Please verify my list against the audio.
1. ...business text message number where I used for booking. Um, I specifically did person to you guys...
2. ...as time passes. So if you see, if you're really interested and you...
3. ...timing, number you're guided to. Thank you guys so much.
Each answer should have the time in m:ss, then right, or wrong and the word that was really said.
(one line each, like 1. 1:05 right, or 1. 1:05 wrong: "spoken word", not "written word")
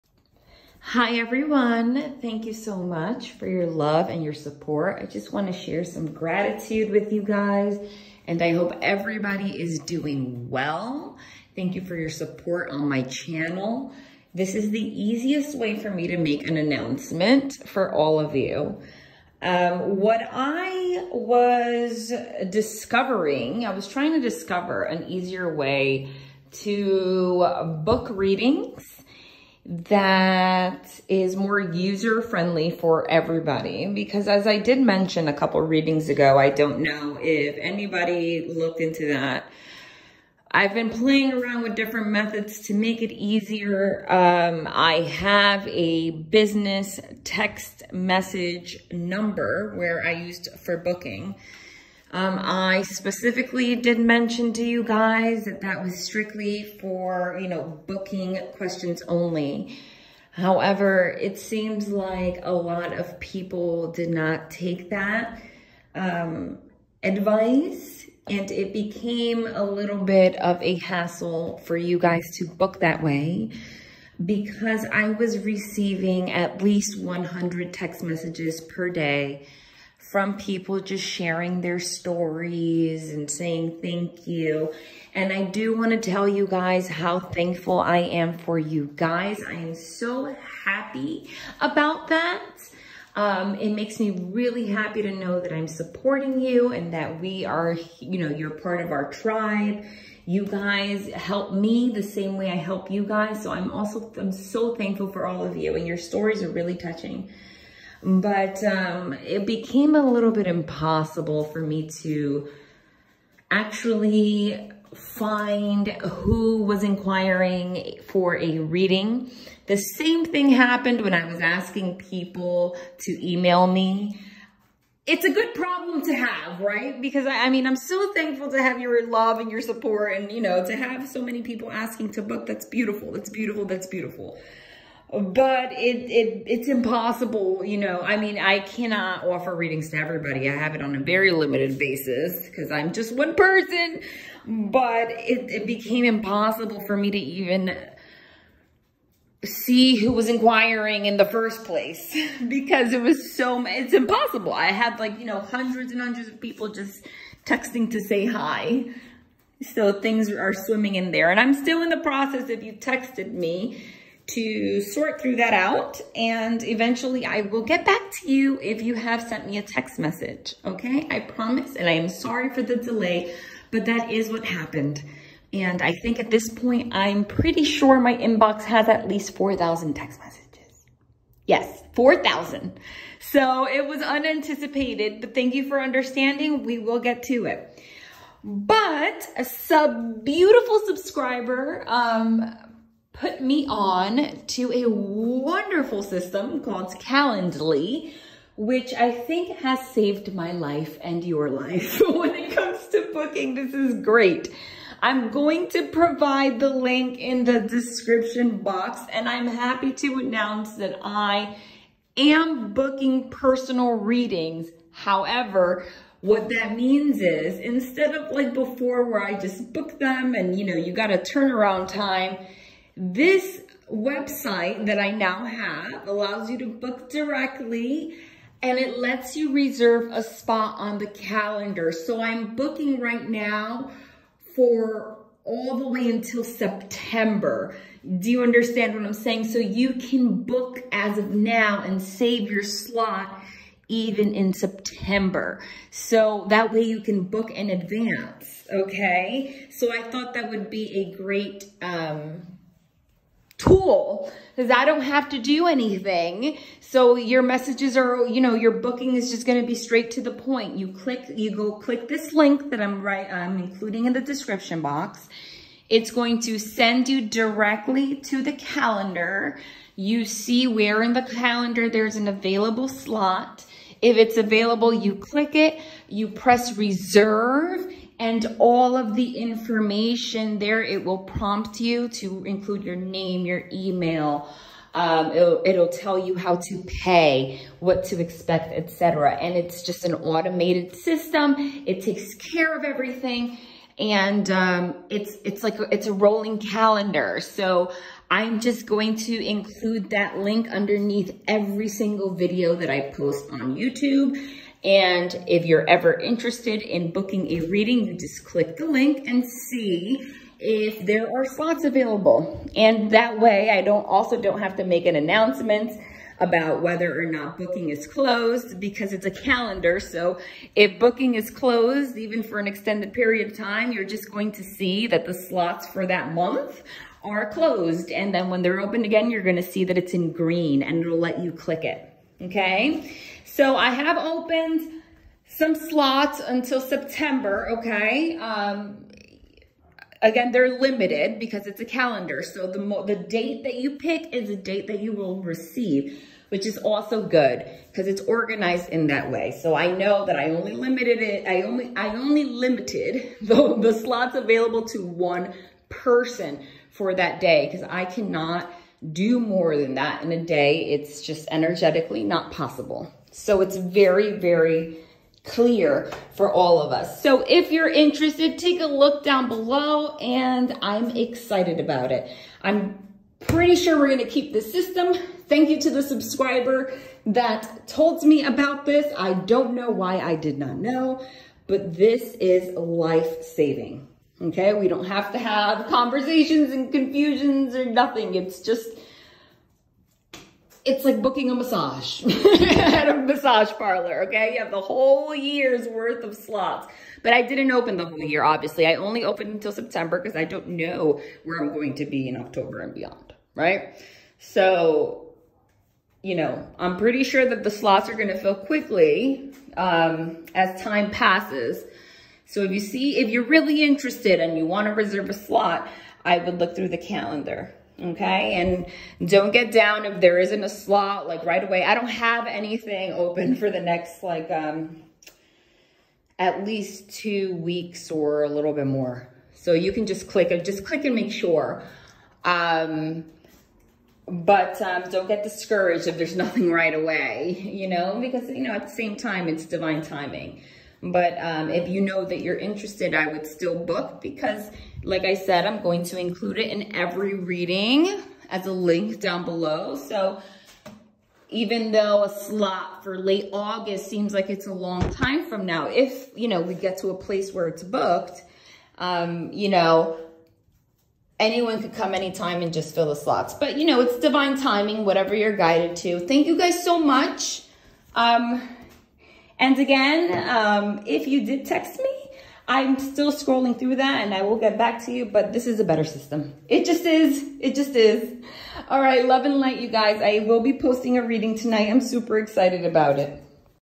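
1. 0:46 wrong: "mention", not "person"
2. 6:50 right
3. 7:44 wrong: "whatever", not "number".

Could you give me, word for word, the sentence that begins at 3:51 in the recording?
So I'm booking right now for all the way until September.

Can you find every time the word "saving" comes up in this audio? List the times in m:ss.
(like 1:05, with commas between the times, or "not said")
6:23.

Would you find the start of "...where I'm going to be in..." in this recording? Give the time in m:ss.
6:41.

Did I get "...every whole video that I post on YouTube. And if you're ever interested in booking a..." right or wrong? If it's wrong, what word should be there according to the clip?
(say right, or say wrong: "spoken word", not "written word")
wrong: "single", not "whole".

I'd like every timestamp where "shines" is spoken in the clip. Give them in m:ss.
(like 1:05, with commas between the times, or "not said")
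not said.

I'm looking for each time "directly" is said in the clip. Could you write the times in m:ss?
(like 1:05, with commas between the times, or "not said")
3:47, 4:27.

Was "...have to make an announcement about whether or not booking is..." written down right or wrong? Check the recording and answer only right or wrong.
right.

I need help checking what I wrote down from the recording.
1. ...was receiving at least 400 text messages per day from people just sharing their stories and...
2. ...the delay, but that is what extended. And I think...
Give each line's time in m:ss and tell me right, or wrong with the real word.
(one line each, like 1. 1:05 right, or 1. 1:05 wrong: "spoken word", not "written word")
1. 1:15 wrong: "100", not "400"
2. 2:52 wrong: "happened", not "extended".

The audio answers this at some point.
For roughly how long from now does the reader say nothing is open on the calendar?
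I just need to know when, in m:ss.
7:07.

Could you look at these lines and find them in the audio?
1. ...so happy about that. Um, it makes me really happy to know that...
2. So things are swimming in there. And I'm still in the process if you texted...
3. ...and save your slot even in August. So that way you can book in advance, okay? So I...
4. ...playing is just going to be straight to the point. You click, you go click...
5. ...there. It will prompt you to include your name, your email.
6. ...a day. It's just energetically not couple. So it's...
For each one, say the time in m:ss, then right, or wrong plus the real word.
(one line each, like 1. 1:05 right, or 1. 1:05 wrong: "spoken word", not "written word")
1. 1:29 right
2. 2:39 right
3. 4:01 wrong: "September", not "August"
4. 4:18 wrong: "booking", not "playing"
5. 4:40 right
6. 6:00 wrong: "possible", not "couple".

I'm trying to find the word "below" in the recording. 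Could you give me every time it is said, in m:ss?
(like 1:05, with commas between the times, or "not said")
6:09, 7:29.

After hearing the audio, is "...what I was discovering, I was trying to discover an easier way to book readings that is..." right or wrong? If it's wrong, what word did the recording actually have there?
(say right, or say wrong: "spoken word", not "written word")
right.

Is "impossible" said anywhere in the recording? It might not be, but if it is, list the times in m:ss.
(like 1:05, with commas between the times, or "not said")
1:50, 2:16, 2:26, 2:33.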